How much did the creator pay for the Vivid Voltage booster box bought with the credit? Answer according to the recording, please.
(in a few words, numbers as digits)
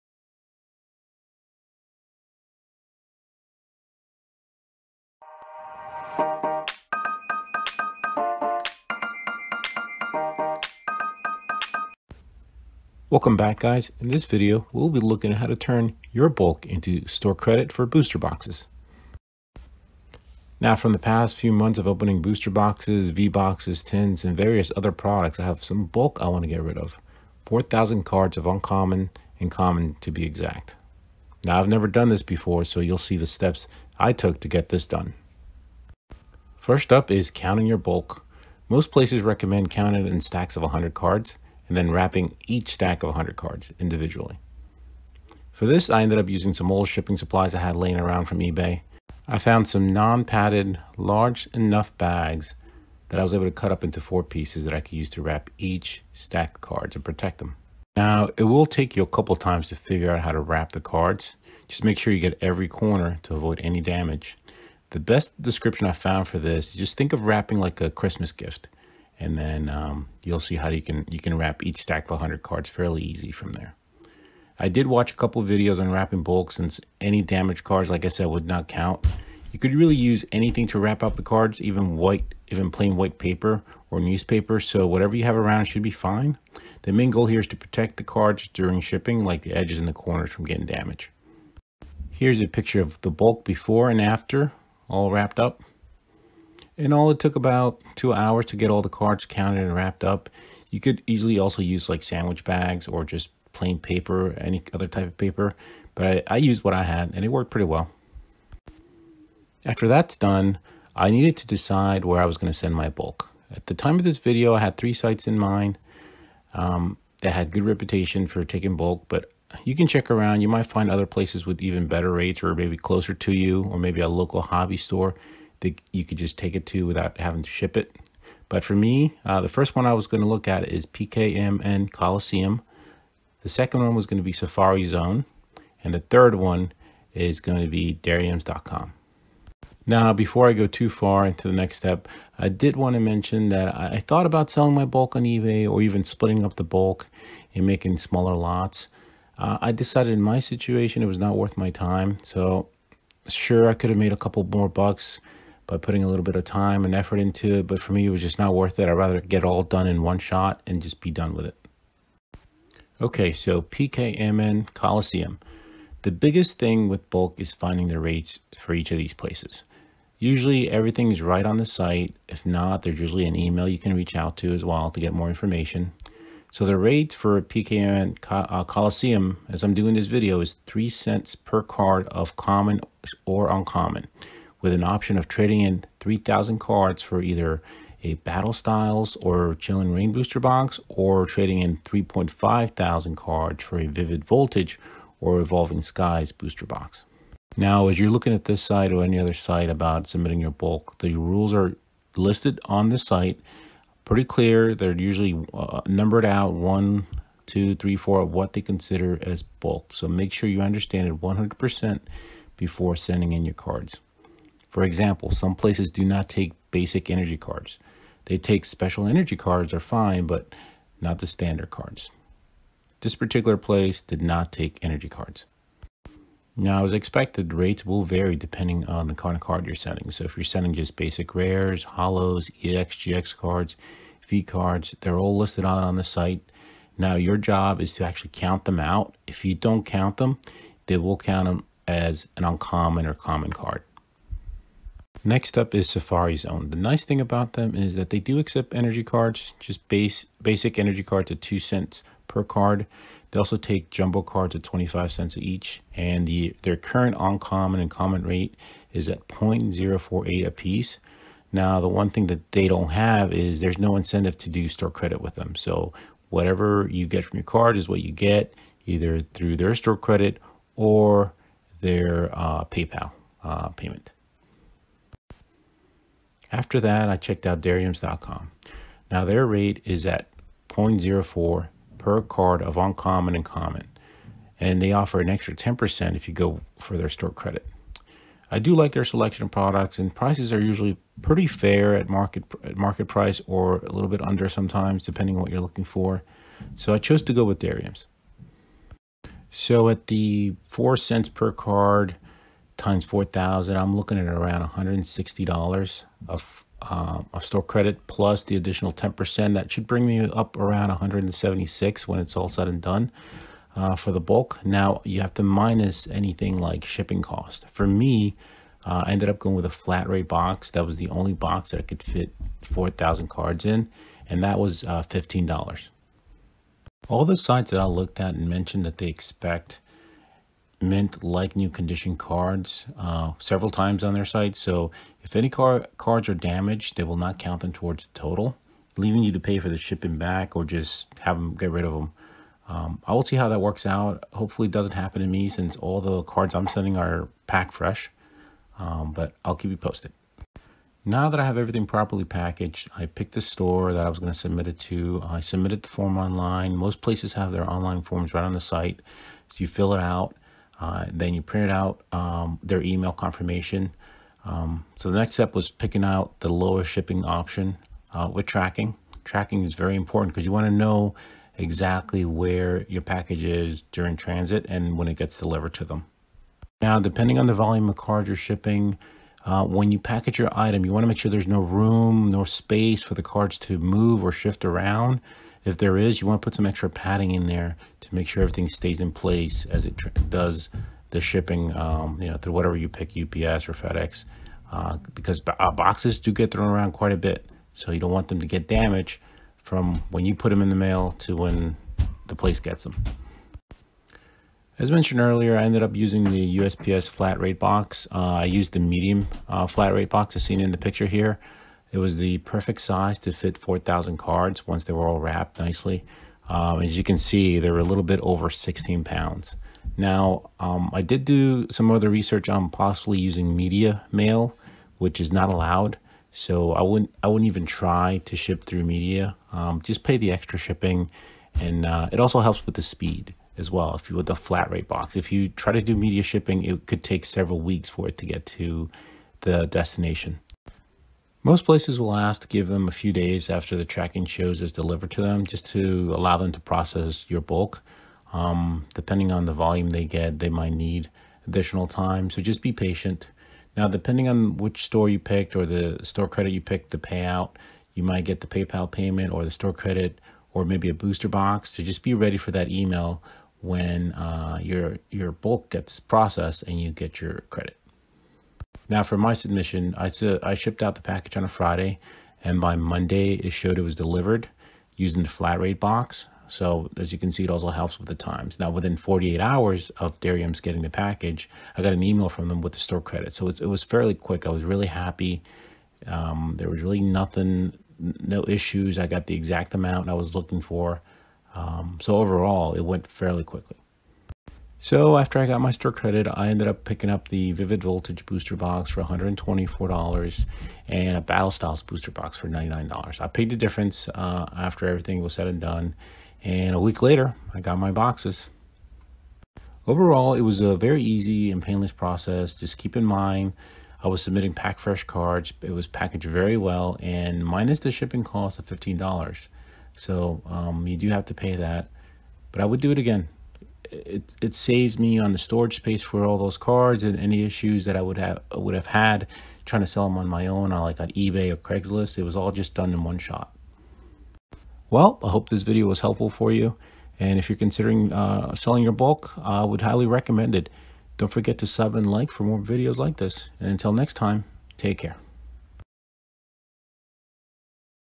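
$124.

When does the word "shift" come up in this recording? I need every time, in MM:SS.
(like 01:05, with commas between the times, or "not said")
06:24.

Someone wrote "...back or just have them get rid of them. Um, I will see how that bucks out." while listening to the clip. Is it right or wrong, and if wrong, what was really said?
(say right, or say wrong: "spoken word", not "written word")
wrong: "works", not "bucks".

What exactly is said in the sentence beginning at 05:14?
Now you have to minus anything like shipping cost.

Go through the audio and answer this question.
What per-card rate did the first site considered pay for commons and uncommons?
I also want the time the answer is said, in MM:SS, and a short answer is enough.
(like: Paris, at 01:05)
3 cents, at 03:00.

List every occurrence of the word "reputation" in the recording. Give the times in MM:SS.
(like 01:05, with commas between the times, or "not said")
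01:57.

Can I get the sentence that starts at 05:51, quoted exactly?
Now that I have everything properly packaged, I picked the store that I was going to submit it to.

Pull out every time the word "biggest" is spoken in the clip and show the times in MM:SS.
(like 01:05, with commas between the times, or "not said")
02:46.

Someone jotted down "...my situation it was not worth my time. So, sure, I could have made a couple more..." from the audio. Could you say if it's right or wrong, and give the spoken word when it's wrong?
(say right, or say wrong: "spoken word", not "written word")
right.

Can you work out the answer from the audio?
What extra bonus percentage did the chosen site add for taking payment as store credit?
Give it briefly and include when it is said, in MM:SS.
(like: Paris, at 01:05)
10%, at 04:45.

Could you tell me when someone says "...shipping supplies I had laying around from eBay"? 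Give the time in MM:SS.
00:46.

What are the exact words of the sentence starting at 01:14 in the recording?
I did watch a couple videos on wrapping bulk since any damaged cards, like I said, would not count.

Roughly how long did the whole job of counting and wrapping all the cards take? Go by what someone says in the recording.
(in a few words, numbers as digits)
about two hours.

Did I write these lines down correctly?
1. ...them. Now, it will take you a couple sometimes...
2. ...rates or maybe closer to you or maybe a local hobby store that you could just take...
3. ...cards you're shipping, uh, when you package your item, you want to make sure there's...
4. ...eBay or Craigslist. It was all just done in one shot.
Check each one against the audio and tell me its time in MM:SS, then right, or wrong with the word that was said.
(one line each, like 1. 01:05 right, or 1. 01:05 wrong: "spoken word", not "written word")
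1. 00:57 wrong: "times", not "sometimes"
2. 02:02 right
3. 06:17 right
4. 08:51 right.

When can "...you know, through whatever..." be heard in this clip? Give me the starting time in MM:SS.
06:32.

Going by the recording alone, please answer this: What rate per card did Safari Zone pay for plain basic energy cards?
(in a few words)
2 cents.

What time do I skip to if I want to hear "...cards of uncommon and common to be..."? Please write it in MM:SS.
00:28.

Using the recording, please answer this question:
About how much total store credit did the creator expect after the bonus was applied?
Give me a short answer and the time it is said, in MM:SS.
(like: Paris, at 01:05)
176, at 05:10.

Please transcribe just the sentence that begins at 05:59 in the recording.
So you fill it out uh, then you printed out um, their email confirmation.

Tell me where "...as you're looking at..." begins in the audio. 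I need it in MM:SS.
03:17.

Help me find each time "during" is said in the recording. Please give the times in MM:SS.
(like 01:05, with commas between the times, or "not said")
01:28, 06:13.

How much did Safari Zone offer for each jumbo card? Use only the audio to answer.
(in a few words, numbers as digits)
25 cents.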